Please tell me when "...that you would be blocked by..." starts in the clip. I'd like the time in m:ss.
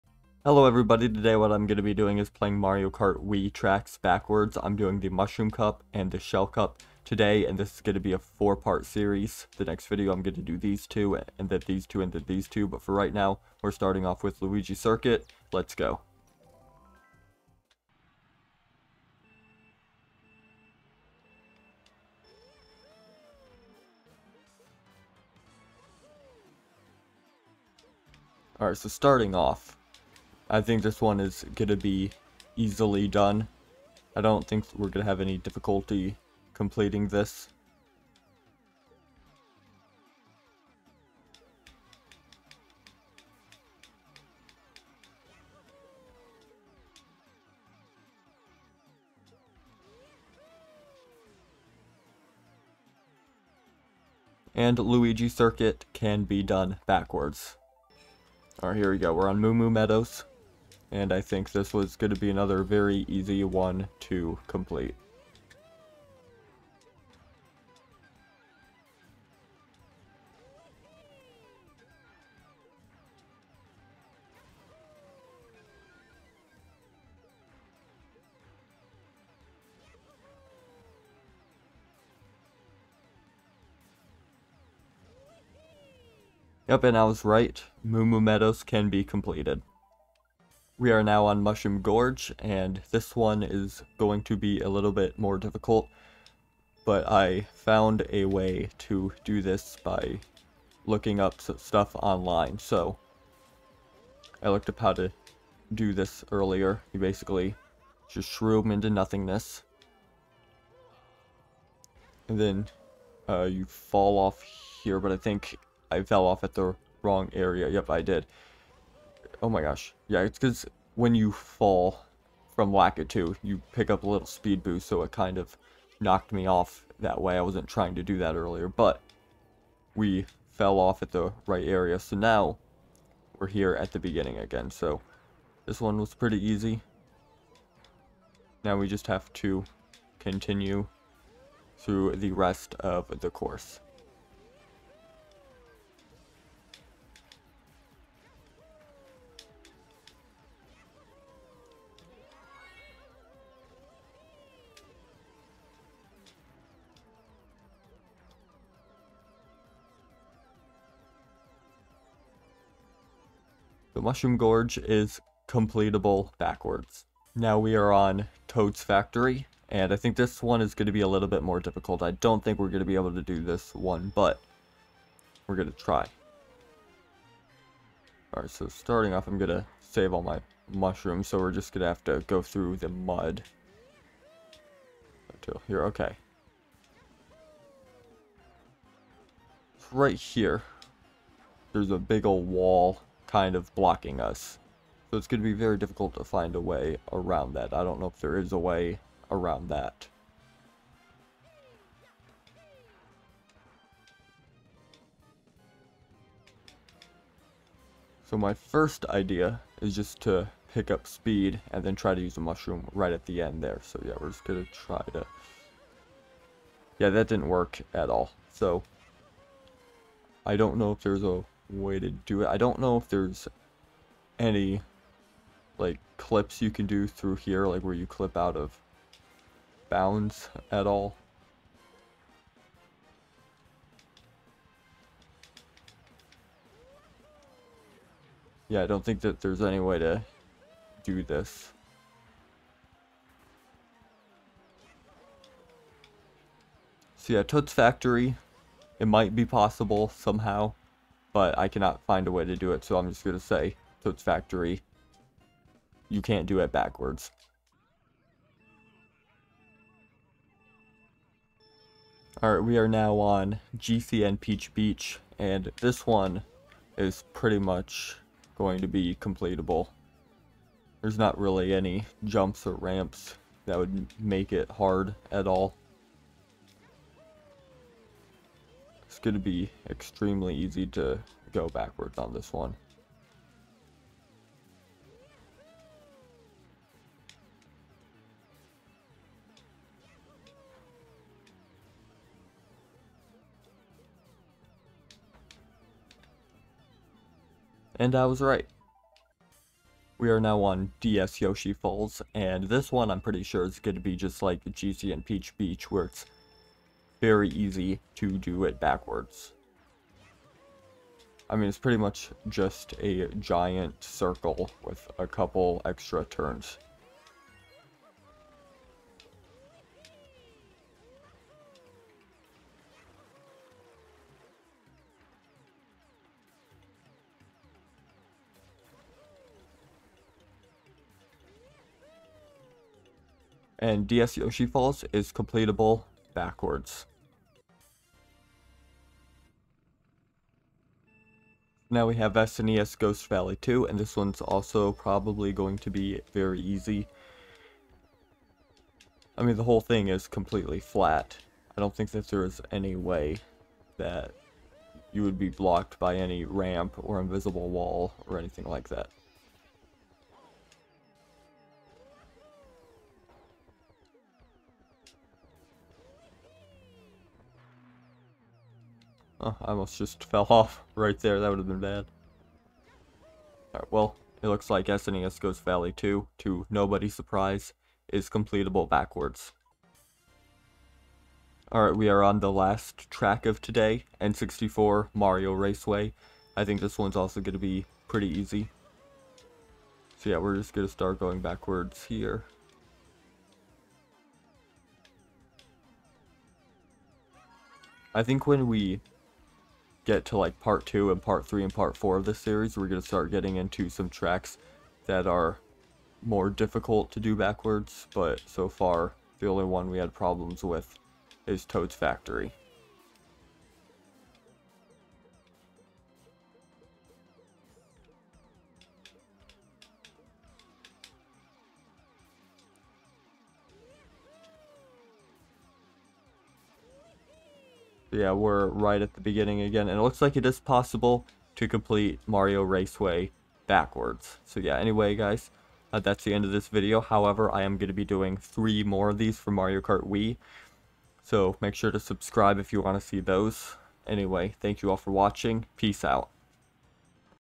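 5:53.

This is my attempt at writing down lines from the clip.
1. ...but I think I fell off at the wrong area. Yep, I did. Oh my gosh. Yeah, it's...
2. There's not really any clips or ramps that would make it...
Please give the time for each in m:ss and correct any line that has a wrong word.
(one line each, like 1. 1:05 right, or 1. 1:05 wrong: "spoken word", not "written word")
1. 1:54 right
2. 4:31 wrong: "jumps", not "clips".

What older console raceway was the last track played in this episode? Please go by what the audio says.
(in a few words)
N64 Mario Raceway.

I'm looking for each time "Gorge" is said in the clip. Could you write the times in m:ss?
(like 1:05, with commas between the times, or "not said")
1:31, 2:44.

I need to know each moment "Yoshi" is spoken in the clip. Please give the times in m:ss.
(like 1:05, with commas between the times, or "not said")
5:01, 5:34.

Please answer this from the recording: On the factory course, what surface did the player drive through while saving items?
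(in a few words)
Mud.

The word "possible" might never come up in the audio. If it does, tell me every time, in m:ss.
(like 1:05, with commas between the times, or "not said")
4:09, 7:10.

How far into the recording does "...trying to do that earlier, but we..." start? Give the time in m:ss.
2:07.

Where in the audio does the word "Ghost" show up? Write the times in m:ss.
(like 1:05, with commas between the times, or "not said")
5:42, 6:15.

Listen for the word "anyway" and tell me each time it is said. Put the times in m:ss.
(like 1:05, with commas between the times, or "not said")
7:14, 7:24.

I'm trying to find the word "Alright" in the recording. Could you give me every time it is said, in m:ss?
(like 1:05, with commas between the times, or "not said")
0:28, 0:58, 2:58, 4:22, 6:13, 6:21.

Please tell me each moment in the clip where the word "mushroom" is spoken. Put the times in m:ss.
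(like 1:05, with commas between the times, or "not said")
0:05, 1:31, 2:44, 3:00, 3:32.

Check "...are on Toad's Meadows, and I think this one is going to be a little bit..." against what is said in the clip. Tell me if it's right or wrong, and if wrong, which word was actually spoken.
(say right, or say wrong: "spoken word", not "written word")
wrong: "Factory", not "Meadows".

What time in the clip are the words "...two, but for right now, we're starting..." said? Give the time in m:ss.
0:12.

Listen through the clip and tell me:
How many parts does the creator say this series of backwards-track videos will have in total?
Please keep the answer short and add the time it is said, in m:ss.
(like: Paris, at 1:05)
4, at 0:08.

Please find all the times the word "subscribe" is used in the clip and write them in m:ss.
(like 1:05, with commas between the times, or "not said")
7:21.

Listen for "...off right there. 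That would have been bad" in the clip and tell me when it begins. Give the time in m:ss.
6:10.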